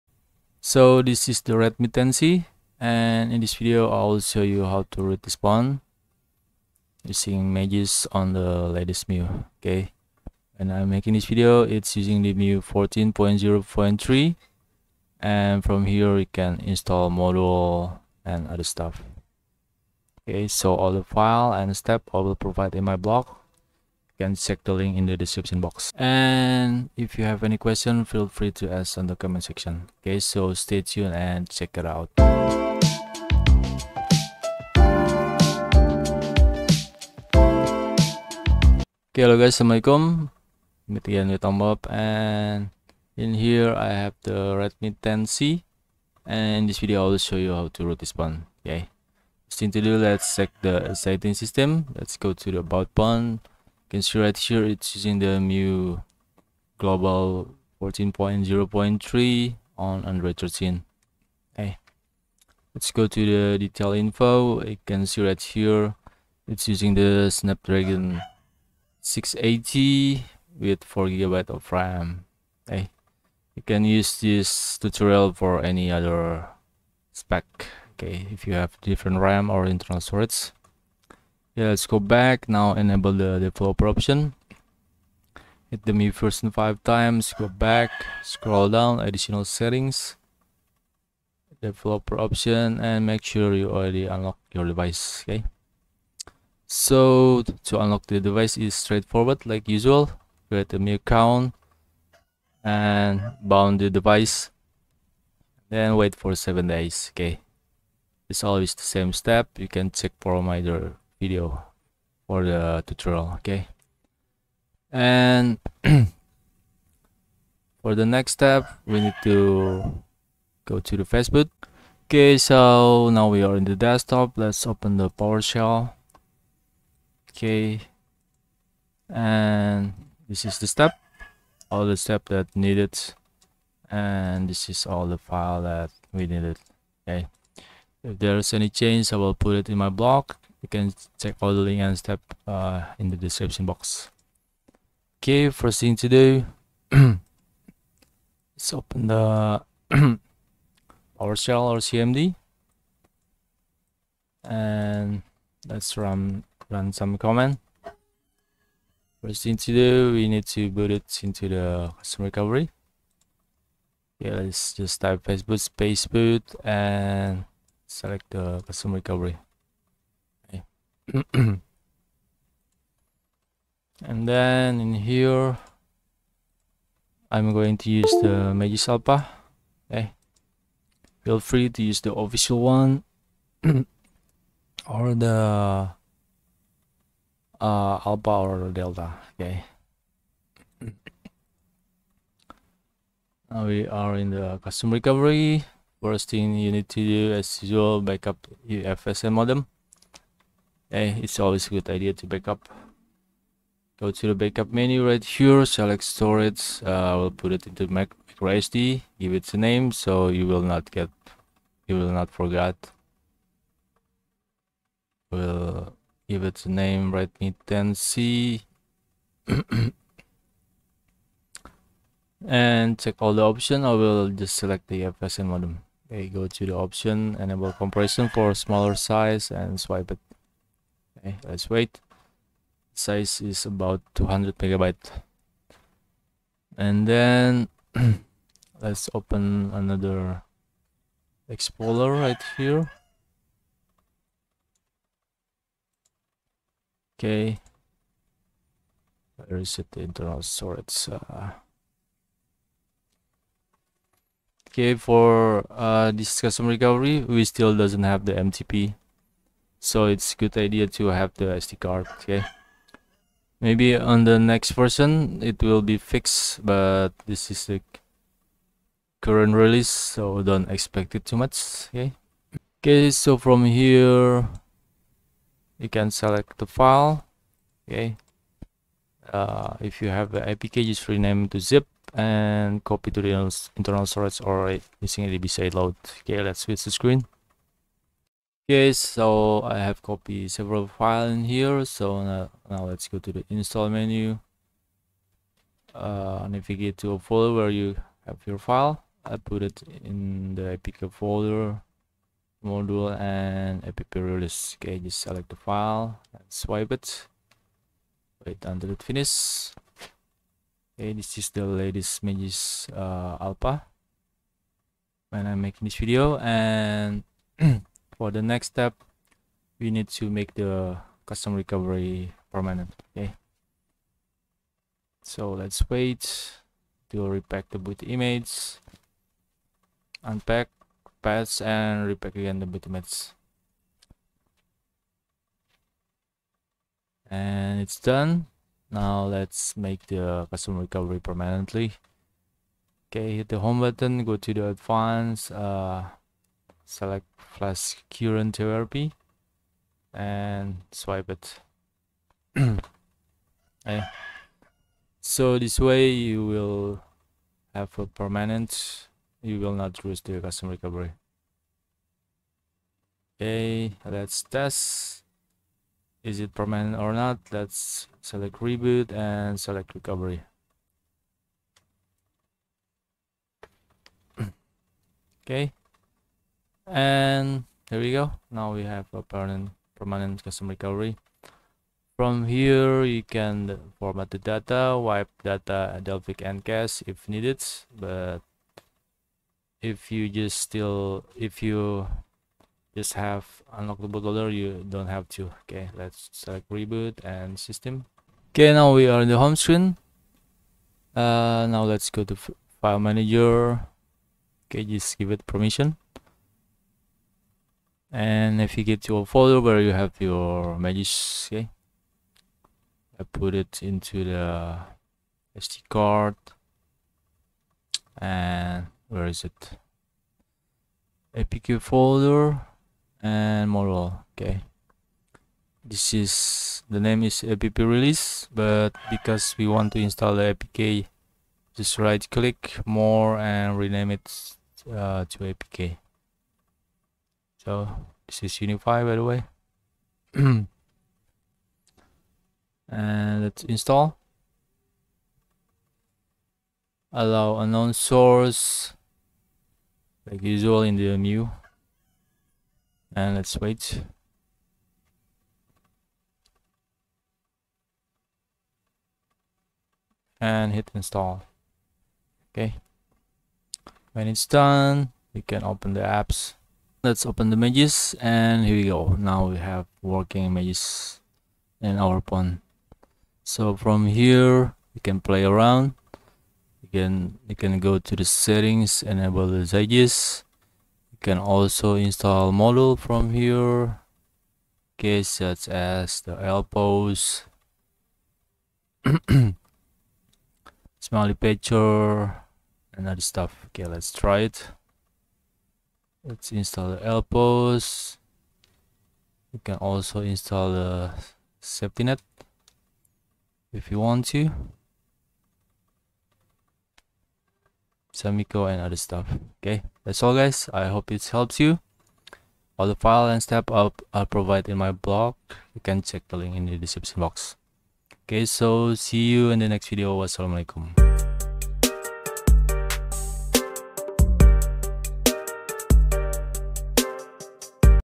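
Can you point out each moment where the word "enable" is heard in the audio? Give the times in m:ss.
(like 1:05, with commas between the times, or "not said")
1:22, 3:47, 7:59.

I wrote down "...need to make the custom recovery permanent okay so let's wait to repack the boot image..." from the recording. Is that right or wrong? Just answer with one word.
right.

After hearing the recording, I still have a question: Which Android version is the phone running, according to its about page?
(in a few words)
Android 13.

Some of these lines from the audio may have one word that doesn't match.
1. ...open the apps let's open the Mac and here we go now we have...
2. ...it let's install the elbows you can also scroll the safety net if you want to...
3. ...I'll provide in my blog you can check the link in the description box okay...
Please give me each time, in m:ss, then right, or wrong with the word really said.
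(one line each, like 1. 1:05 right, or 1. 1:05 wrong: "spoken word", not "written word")
1. 7:45 wrong: "Magisk", not "Mac"
2. 8:14 wrong: "install", not "scroll"
3. 8:34 right.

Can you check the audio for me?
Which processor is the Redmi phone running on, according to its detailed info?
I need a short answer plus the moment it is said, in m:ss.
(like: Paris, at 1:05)
Snapdragon 680, at 1:07.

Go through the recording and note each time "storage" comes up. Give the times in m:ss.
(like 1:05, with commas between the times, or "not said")
1:19, 3:26, 4:10, 4:44.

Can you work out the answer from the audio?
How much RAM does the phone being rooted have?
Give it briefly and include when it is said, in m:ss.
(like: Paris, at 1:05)
4 gigabytes, at 1:10.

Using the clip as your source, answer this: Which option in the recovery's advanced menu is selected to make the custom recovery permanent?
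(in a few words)
flash current therapy.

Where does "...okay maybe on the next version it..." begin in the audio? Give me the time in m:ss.
4:22.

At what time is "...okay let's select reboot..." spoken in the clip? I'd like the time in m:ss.
6:35.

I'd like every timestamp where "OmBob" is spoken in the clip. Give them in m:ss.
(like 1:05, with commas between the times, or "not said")
0:41.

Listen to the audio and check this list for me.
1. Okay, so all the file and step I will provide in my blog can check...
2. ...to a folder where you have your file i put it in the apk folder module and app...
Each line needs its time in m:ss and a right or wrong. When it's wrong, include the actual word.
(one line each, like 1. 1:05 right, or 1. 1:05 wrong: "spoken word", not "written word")
1. 0:20 right
2. 4:56 right.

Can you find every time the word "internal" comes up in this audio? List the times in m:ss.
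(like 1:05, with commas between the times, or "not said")
1:19, 4:10, 4:43.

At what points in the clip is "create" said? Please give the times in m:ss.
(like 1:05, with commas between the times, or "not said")
1:40.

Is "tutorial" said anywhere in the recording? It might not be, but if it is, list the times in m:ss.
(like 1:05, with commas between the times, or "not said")
1:14, 1:52.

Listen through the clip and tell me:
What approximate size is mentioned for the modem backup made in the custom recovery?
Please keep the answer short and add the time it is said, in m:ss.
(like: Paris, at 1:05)
200 megabytes, at 3:54.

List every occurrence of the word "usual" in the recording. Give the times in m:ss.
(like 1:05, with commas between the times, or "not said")
1:39, 3:17, 7:30.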